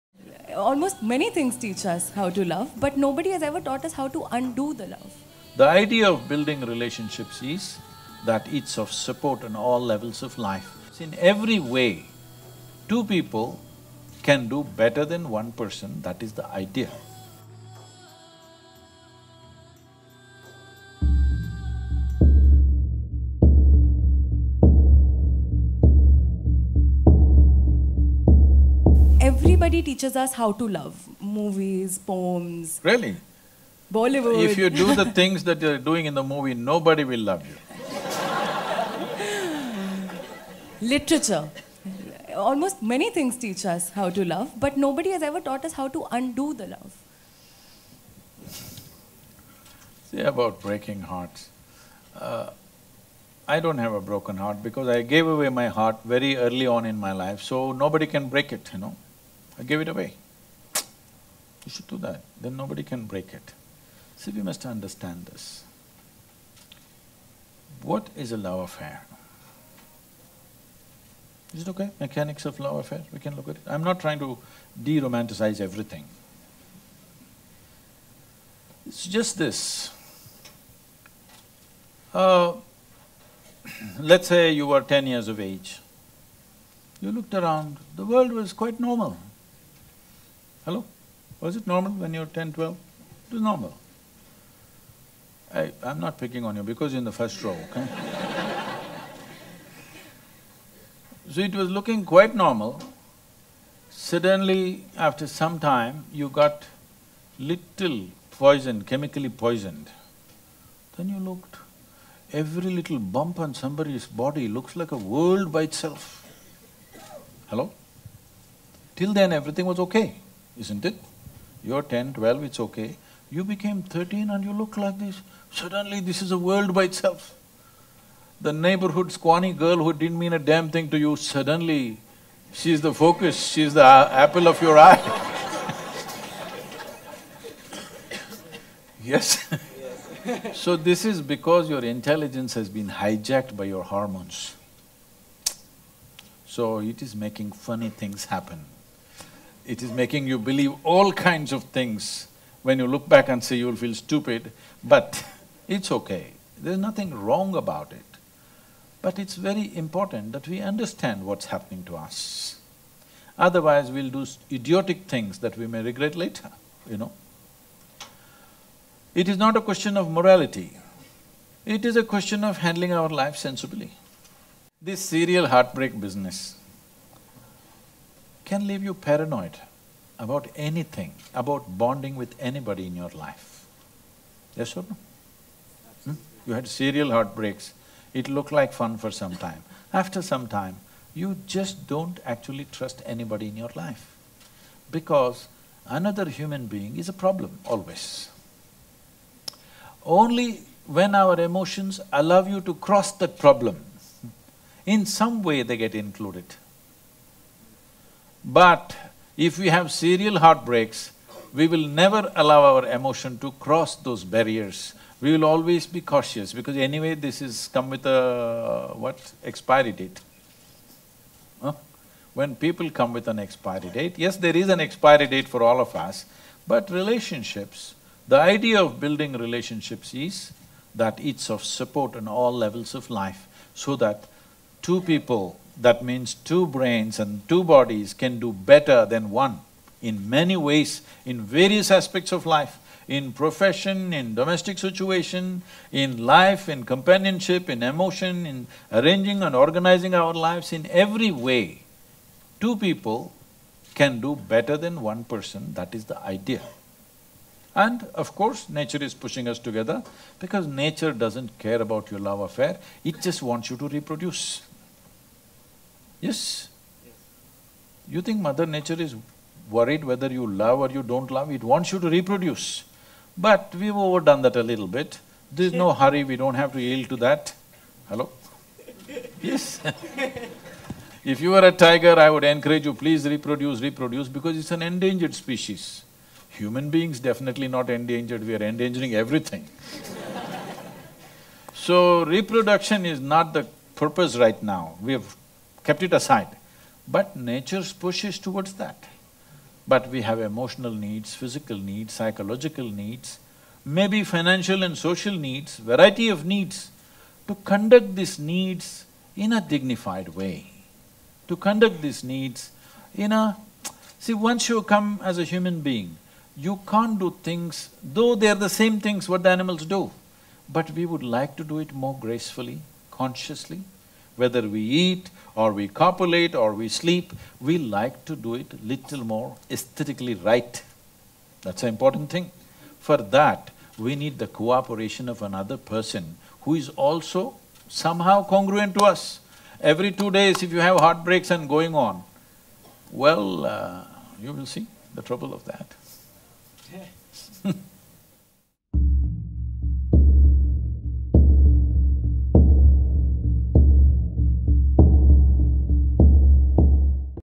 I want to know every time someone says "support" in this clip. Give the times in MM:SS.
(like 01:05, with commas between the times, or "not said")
00:08, 03:51.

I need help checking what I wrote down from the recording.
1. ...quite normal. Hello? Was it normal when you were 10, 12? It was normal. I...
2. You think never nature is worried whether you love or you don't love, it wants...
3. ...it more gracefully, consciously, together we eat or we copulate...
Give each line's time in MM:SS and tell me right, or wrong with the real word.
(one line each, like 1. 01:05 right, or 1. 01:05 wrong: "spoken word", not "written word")
1. 01:28 right
2. 04:28 wrong: "mother", not "never"
3. 05:21 wrong: "whether", not "together".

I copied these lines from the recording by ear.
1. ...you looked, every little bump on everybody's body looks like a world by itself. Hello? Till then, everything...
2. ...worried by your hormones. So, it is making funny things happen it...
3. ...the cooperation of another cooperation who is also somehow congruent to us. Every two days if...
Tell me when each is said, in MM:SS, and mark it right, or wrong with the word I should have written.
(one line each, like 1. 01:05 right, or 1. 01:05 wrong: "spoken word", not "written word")
1. 01:51 wrong: "somebody", not "everybody"
2. 02:22 wrong: "hijacked", not "worried"
3. 05:34 wrong: "person", not "cooperation".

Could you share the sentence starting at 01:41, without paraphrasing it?
so it was looking quite normal.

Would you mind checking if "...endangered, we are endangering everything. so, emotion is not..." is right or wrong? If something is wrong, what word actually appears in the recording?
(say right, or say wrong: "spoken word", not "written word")
wrong: "reproduction", not "emotion".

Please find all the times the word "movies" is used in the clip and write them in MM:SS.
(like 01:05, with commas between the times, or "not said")
00:31, 00:36.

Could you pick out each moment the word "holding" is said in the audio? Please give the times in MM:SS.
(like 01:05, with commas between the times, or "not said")
not said.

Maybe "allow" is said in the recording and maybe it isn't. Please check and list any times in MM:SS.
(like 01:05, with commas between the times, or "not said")
03:22, 03:32.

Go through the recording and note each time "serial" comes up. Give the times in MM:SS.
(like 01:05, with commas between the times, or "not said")
02:55, 03:06, 03:29.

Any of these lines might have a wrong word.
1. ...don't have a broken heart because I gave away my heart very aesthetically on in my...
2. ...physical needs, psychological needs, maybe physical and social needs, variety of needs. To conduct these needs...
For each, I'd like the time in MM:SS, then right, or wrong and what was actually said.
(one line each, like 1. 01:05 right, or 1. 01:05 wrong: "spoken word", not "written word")
1. 00:53 wrong: "early", not "aesthetically"
2. 05:01 wrong: "financial", not "physical".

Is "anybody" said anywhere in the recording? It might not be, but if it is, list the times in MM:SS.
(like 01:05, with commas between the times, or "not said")
03:02, 03:13.